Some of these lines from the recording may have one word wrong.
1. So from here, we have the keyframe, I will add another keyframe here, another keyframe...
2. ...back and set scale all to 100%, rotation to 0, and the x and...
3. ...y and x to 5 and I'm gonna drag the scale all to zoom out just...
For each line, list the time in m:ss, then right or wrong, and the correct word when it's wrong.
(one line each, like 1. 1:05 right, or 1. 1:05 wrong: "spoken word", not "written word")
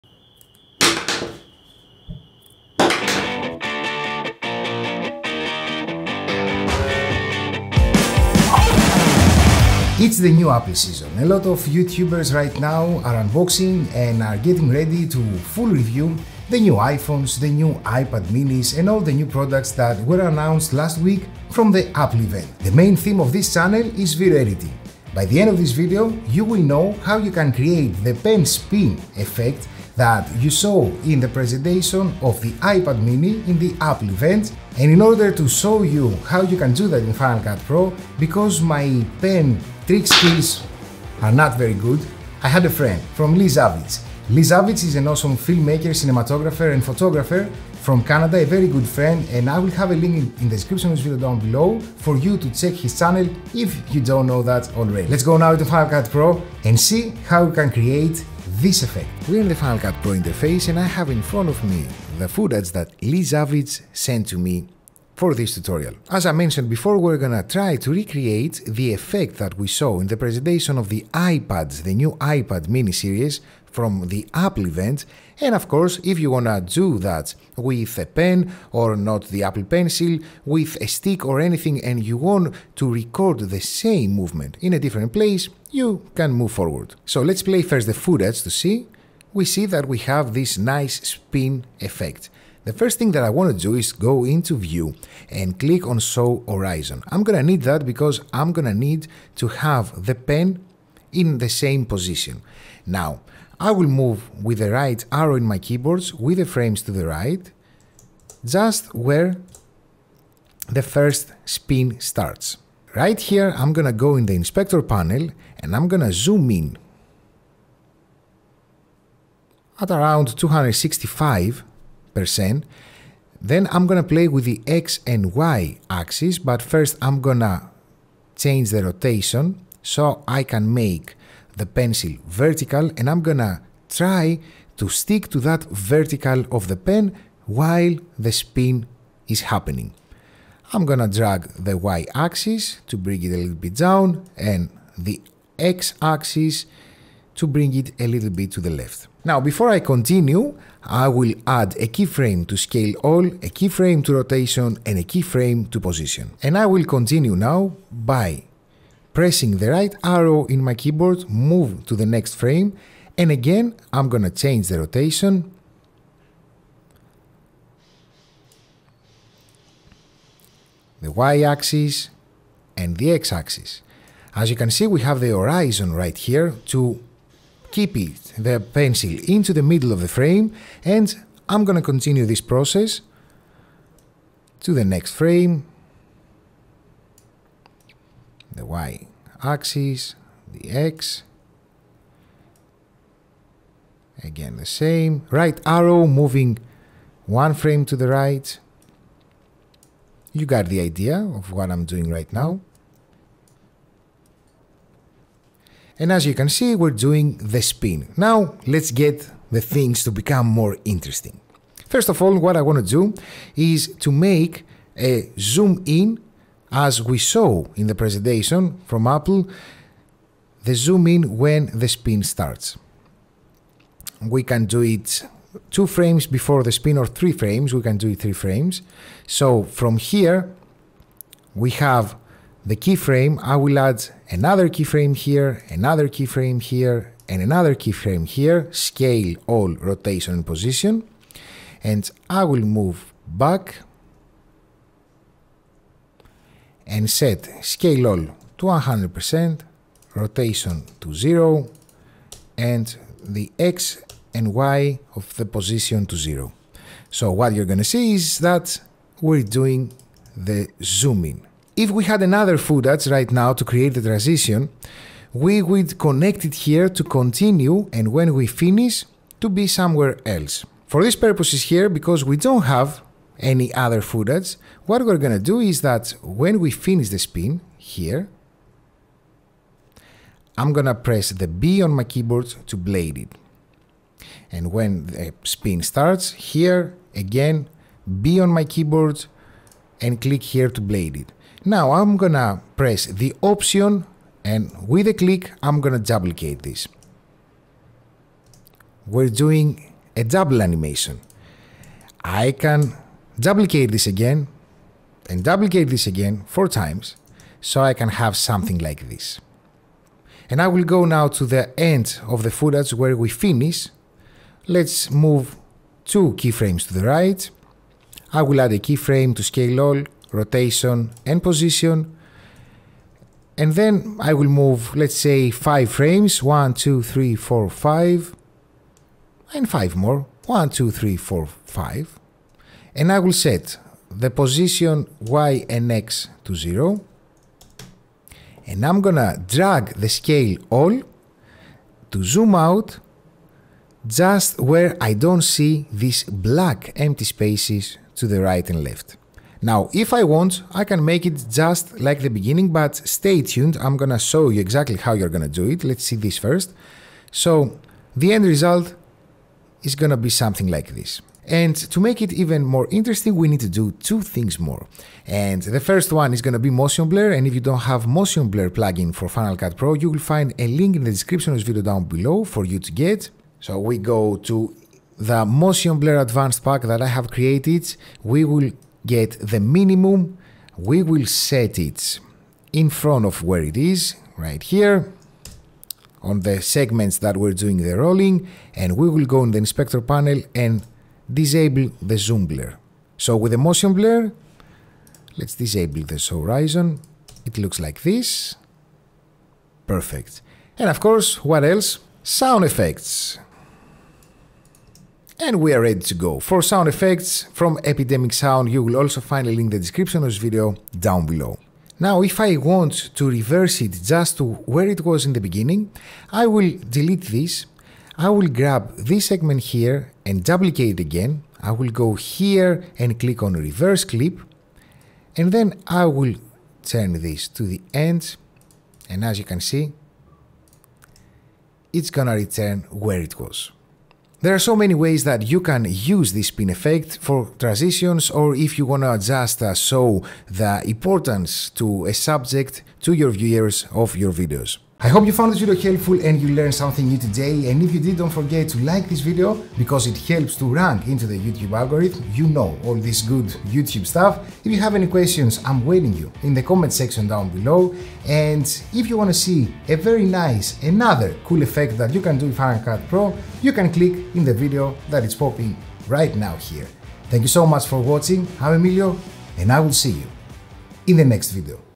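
1. 3:49 right
2. 4:03 right
3. 5:35 wrong: "0", not "5".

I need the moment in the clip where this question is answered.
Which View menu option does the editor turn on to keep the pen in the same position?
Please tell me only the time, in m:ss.
1:35.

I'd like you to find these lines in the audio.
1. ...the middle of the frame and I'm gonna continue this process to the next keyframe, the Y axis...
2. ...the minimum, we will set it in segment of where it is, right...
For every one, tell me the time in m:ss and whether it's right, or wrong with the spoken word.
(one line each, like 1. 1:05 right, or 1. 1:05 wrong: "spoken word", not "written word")
1. 2:59 wrong: "frame", not "keyframe"
2. 6:19 wrong: "front", not "segment".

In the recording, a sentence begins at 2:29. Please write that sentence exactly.
Now, before I continue, I will add a keyframe to scale all, a keyframe to rotation, and a keyframe to position.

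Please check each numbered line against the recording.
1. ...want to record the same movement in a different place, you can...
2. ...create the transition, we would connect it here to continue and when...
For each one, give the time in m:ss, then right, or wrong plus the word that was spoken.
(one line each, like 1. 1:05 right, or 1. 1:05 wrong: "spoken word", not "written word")
1. 1:22 right
2. 4:23 right.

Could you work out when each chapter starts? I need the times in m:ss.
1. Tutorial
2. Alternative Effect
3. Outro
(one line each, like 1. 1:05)
1. 1:00
2. 6:52
3. 7:24.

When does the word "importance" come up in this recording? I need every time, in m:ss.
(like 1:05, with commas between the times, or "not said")
7:20.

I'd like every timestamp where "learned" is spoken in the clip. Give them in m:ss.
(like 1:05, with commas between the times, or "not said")
7:26.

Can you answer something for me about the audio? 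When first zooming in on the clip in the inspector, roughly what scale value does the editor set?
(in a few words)
265.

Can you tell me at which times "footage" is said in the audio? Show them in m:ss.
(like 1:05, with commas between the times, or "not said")
1:02, 1:28, 4:22, 4:34, 5:12.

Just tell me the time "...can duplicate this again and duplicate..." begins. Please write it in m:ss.
5:02.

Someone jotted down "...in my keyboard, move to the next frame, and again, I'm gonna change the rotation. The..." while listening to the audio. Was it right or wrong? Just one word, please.
right.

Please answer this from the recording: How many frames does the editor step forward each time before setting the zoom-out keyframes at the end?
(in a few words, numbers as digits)
5.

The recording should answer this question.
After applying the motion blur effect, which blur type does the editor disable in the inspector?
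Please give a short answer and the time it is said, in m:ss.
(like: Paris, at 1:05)
Zoom blur, at 6:32.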